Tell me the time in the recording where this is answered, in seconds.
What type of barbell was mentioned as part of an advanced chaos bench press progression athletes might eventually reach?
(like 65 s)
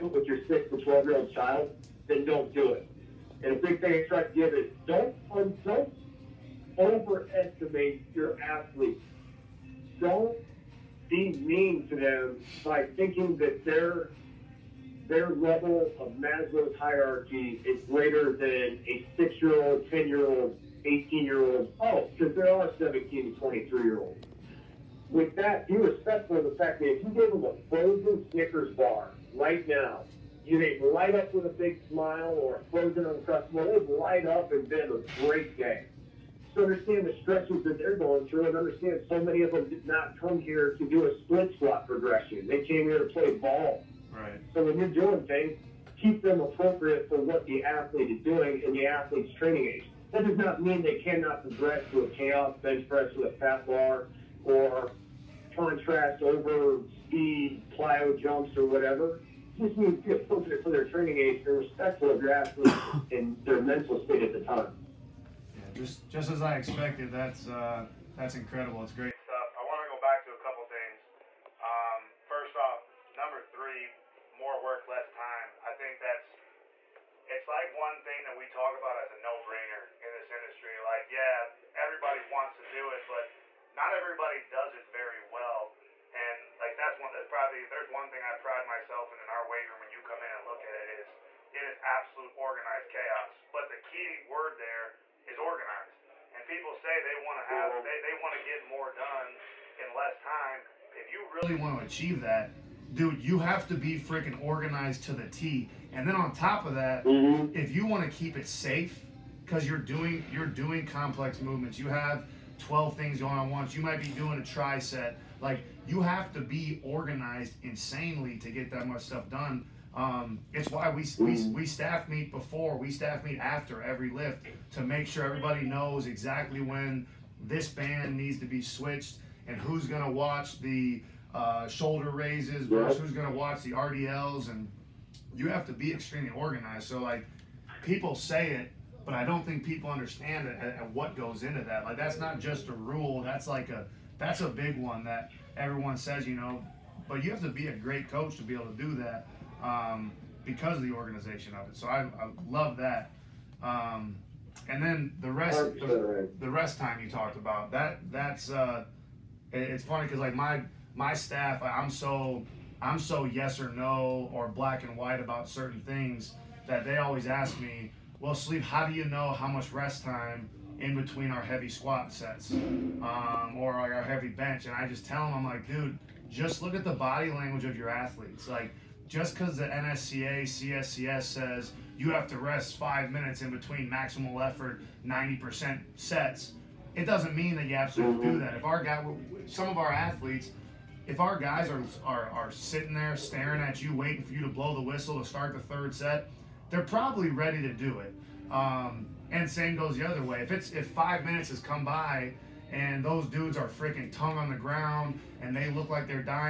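53 s.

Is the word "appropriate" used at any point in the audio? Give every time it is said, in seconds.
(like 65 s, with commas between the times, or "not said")
46 s, 60 s.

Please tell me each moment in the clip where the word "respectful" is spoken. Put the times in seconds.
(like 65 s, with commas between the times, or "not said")
25 s, 61 s.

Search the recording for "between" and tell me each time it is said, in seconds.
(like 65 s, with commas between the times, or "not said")
170 s, 183 s.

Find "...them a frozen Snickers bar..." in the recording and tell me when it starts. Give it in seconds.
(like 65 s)
27 s.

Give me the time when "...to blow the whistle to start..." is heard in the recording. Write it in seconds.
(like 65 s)
194 s.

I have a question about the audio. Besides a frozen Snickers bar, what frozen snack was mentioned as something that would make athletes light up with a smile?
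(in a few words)
Uncrustable.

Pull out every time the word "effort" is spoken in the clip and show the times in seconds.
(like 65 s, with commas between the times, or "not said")
184 s.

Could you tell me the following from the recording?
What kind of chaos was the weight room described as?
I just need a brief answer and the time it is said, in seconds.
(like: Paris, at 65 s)
Organized chaos, at 92 s.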